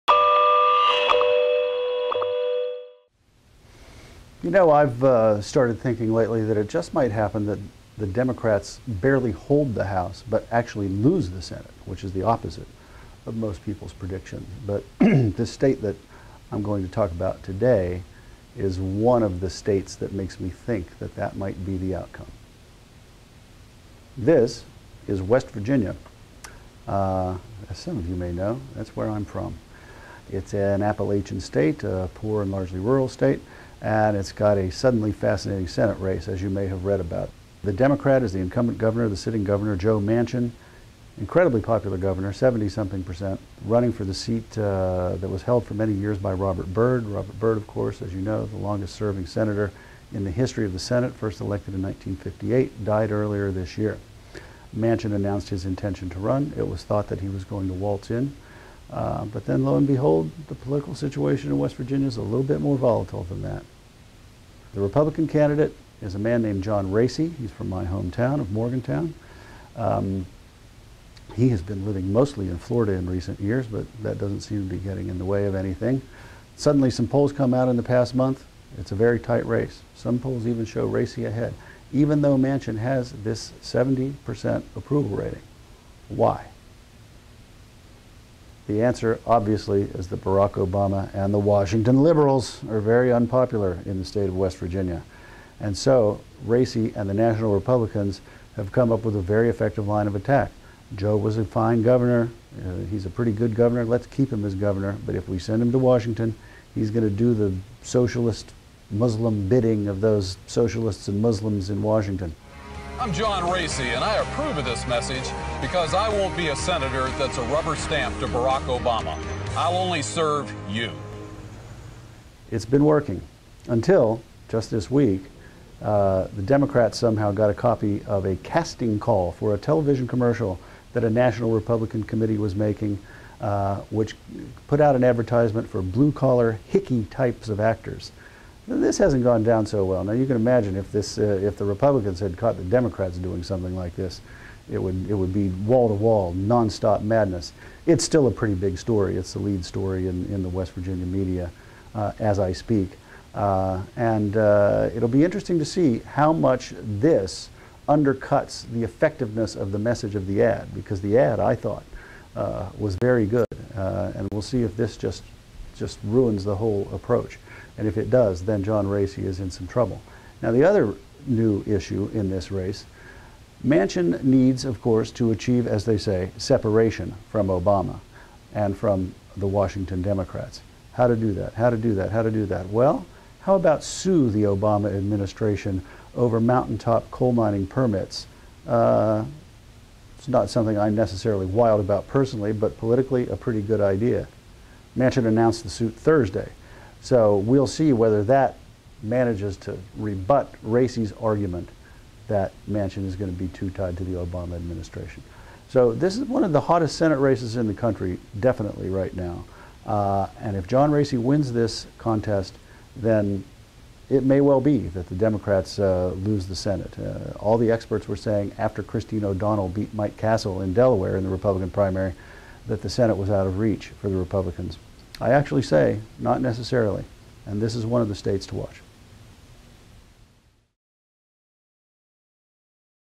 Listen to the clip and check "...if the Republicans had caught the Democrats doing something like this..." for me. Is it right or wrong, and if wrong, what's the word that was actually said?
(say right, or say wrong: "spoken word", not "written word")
right.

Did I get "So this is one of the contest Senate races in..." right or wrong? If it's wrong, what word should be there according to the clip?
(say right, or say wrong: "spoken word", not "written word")
wrong: "hottest", not "contest".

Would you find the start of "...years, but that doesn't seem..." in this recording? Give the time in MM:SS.
01:13.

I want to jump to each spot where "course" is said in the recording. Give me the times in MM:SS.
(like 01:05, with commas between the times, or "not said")
00:47, 02:54.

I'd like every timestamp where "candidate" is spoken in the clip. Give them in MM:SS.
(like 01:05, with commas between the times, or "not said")
01:05.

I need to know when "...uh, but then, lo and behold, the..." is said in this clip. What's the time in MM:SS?
00:58.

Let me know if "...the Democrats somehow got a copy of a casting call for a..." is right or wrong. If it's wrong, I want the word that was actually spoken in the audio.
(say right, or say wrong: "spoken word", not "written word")
right.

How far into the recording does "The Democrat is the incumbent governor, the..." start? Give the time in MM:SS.
00:37.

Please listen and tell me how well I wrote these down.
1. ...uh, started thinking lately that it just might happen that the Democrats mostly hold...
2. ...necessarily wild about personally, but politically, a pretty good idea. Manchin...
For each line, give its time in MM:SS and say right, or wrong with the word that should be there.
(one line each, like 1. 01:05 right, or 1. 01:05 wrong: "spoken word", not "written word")
1. 00:05 wrong: "barely", not "mostly"
2. 03:10 right.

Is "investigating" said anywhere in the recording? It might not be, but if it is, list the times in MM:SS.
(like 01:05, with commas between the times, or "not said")
not said.